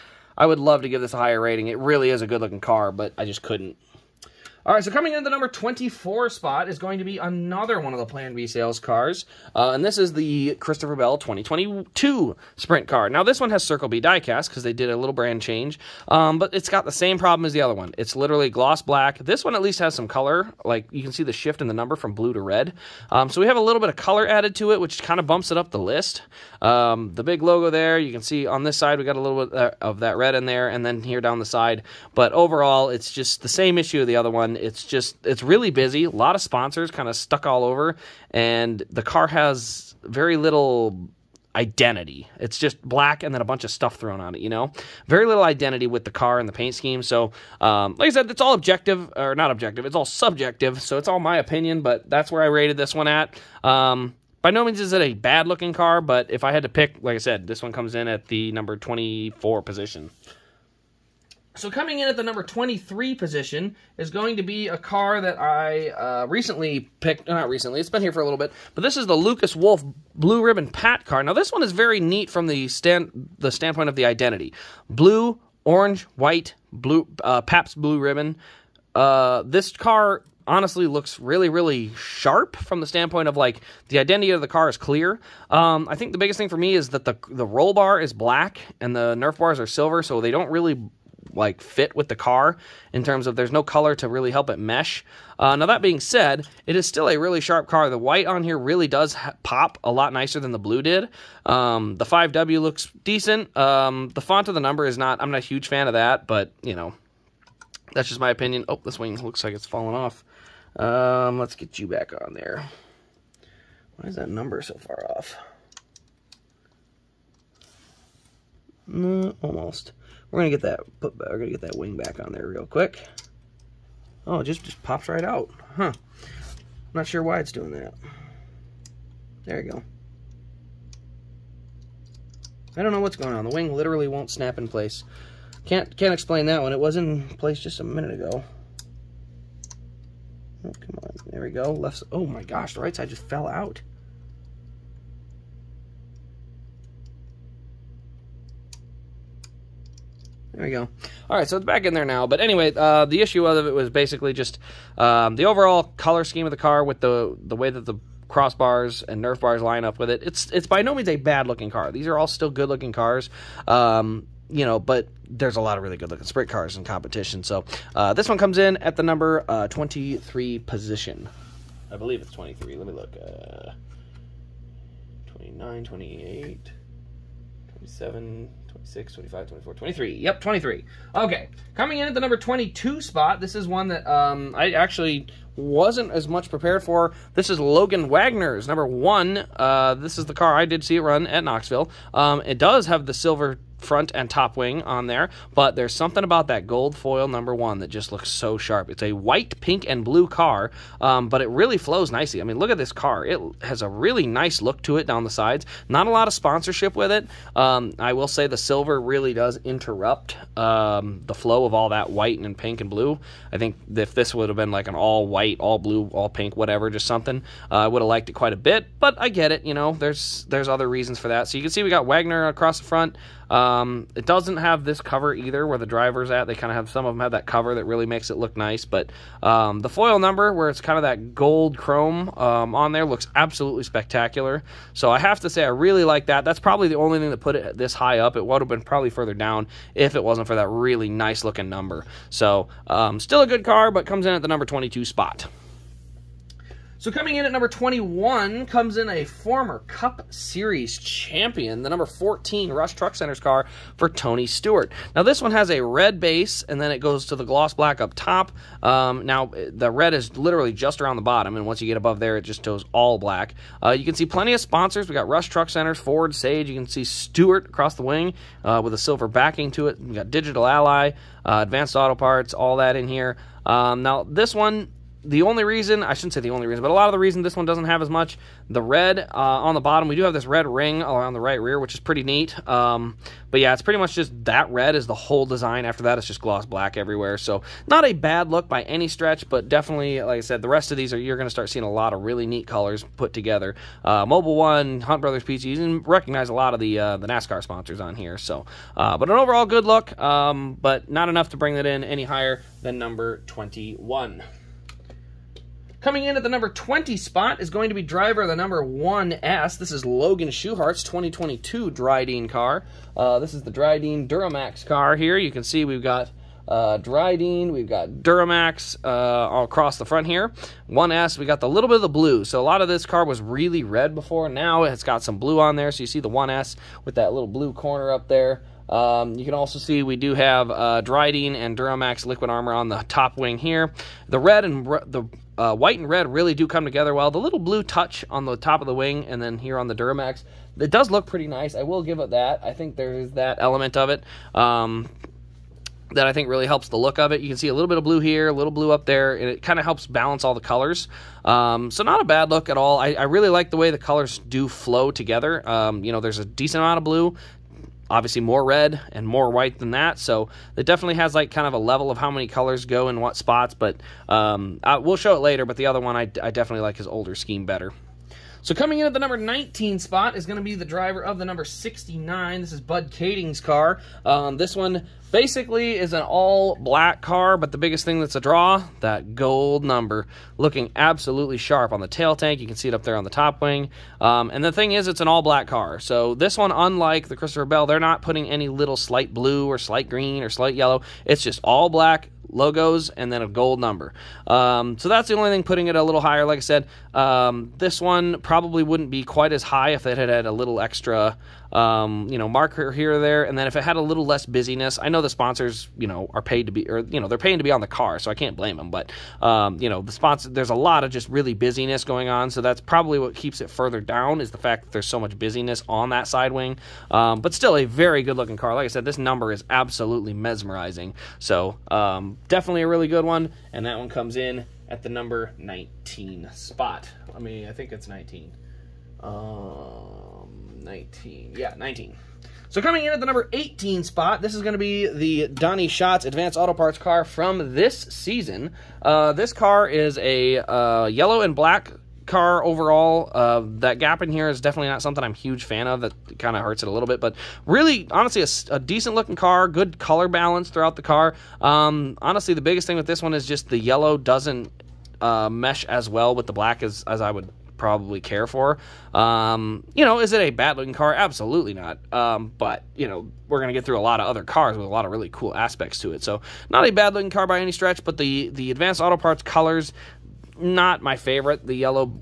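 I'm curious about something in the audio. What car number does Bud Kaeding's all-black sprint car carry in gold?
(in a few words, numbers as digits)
69.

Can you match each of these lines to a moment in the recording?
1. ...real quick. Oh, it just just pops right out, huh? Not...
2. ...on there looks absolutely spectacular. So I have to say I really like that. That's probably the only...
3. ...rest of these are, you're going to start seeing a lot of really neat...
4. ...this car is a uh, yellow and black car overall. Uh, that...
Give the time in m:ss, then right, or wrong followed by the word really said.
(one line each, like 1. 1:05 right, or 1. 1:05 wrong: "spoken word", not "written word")
1. 2:02 right
2. 3:52 right
3. 4:50 right
4. 7:19 right.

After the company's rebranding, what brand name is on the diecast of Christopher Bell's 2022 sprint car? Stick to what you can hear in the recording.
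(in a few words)
Circle B.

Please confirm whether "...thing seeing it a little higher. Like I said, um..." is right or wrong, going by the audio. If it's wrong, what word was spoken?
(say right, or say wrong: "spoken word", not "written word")
wrong: "putting", not "seeing".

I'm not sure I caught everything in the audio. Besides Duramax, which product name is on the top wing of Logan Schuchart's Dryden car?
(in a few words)
Liquid Armor.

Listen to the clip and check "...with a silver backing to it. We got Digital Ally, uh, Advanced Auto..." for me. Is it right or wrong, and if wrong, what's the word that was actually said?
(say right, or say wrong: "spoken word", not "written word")
right.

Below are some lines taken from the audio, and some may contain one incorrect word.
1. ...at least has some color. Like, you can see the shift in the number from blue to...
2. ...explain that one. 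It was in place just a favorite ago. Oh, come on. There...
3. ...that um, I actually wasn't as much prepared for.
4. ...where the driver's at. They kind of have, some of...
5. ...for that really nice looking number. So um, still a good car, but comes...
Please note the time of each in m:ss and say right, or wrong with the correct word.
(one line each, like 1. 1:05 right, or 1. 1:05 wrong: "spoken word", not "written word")
1. 0:19 right
2. 2:16 wrong: "minute", not "favorite"
3. 3:03 right
4. 3:45 right
5. 4:00 right.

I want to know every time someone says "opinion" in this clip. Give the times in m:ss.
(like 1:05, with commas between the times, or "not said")
0:51, 1:48.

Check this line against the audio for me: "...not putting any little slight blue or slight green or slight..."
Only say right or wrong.
right.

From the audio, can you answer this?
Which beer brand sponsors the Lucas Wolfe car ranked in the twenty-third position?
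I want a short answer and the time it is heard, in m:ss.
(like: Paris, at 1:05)
Pabst Blue Ribbon, at 1:17.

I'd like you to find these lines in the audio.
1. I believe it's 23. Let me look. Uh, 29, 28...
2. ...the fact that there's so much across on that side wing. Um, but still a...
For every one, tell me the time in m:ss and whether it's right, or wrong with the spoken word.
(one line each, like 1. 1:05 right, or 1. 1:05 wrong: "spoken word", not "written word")
1. 2:51 right
2. 6:54 wrong: "busyness", not "across".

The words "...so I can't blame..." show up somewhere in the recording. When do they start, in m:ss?
6:48.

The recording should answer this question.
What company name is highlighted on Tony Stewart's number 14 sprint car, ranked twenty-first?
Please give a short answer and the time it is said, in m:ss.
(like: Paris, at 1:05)
Rush Truck Centers, at 4:12.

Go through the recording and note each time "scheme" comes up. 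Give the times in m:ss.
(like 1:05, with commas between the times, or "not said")
0:46, 2:36, 6:07.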